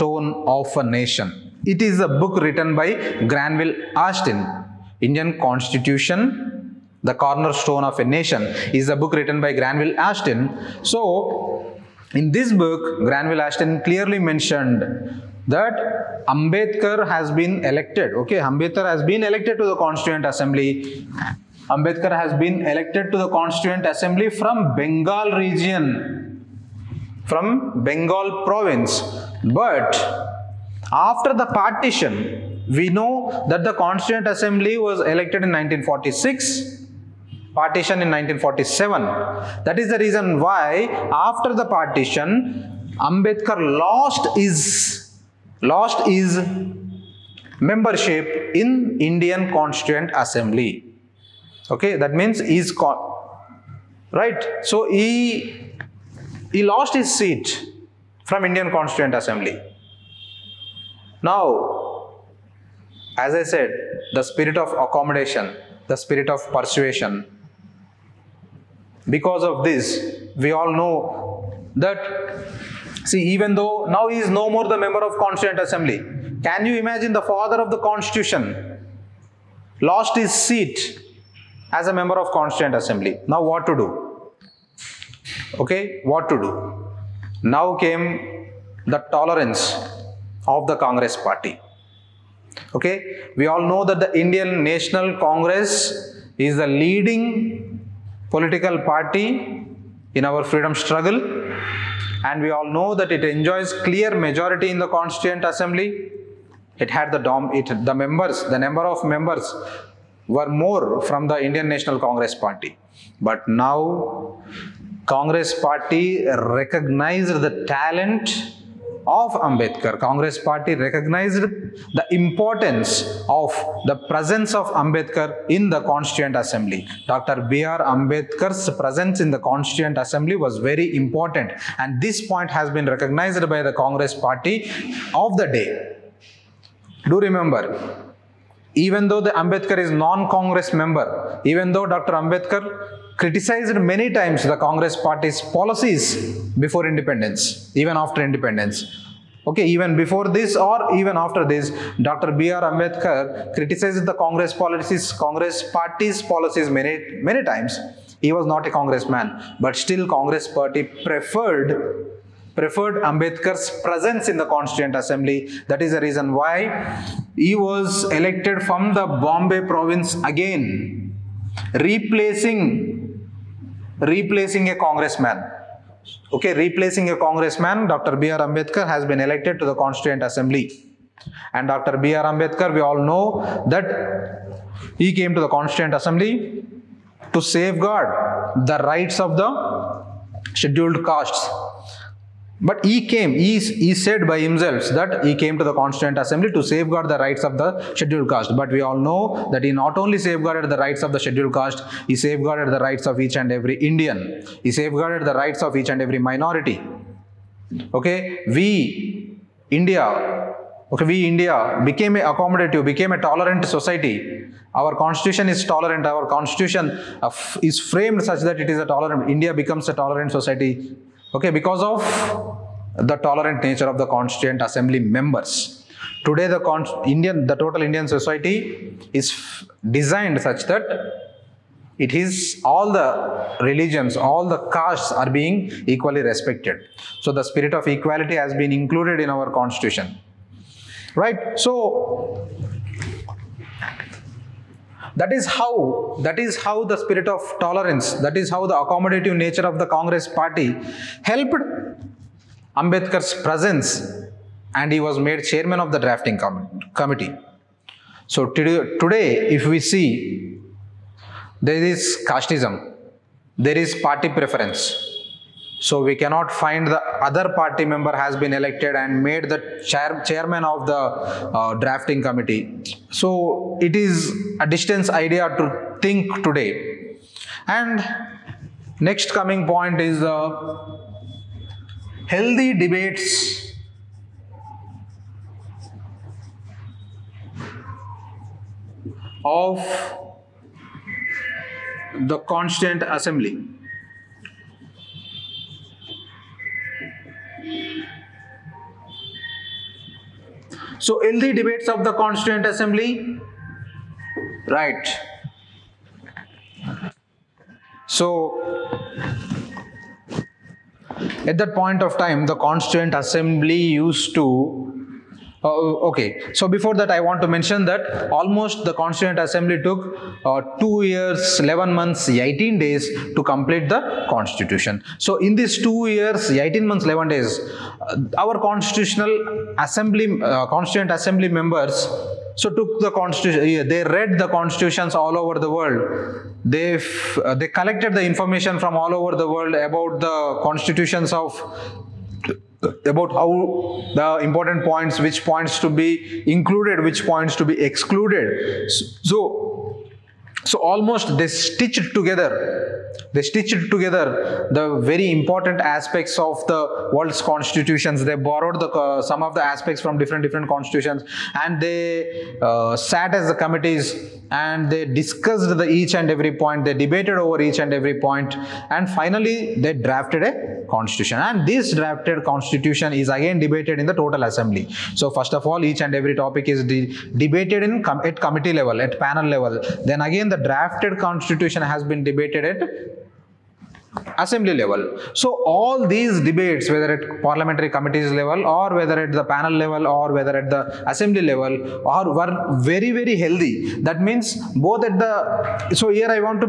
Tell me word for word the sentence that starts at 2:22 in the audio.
Ambedkar criticized many times the Congress party's policies before independence, even after independence.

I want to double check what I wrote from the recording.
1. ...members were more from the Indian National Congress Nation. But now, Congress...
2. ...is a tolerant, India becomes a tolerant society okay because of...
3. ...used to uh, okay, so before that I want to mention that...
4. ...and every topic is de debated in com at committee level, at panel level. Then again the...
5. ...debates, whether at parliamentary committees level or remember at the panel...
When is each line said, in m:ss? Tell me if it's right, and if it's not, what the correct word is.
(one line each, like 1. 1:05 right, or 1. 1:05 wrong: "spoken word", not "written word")
1. 1:49 wrong: "Party", not "Nation"
2. 3:38 right
3. 5:13 right
4. 6:16 right
5. 6:26 wrong: "whether", not "remember".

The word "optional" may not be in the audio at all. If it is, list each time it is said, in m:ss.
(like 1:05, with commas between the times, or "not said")
not said.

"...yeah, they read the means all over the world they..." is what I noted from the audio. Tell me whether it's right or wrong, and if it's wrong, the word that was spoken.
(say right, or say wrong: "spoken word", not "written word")
wrong: "constitutions", not "means".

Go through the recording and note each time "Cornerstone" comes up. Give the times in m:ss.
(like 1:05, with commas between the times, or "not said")
0:07.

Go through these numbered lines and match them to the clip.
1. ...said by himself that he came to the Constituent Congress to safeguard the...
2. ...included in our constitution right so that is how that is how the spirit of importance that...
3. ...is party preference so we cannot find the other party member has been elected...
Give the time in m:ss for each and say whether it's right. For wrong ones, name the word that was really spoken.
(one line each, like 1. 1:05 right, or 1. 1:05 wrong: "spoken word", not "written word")
1. 3:13 wrong: "Assembly", not "Congress"
2. 3:58 wrong: "tolerance", not "importance"
3. 4:23 right.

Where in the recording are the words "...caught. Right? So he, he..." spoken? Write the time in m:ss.
0:52.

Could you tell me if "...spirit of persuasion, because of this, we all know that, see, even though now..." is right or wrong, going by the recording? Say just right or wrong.
right.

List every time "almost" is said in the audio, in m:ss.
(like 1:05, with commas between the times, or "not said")
5:18, 5:50.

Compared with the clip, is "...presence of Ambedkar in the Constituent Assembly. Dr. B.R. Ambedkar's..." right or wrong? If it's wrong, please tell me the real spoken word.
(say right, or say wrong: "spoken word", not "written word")
right.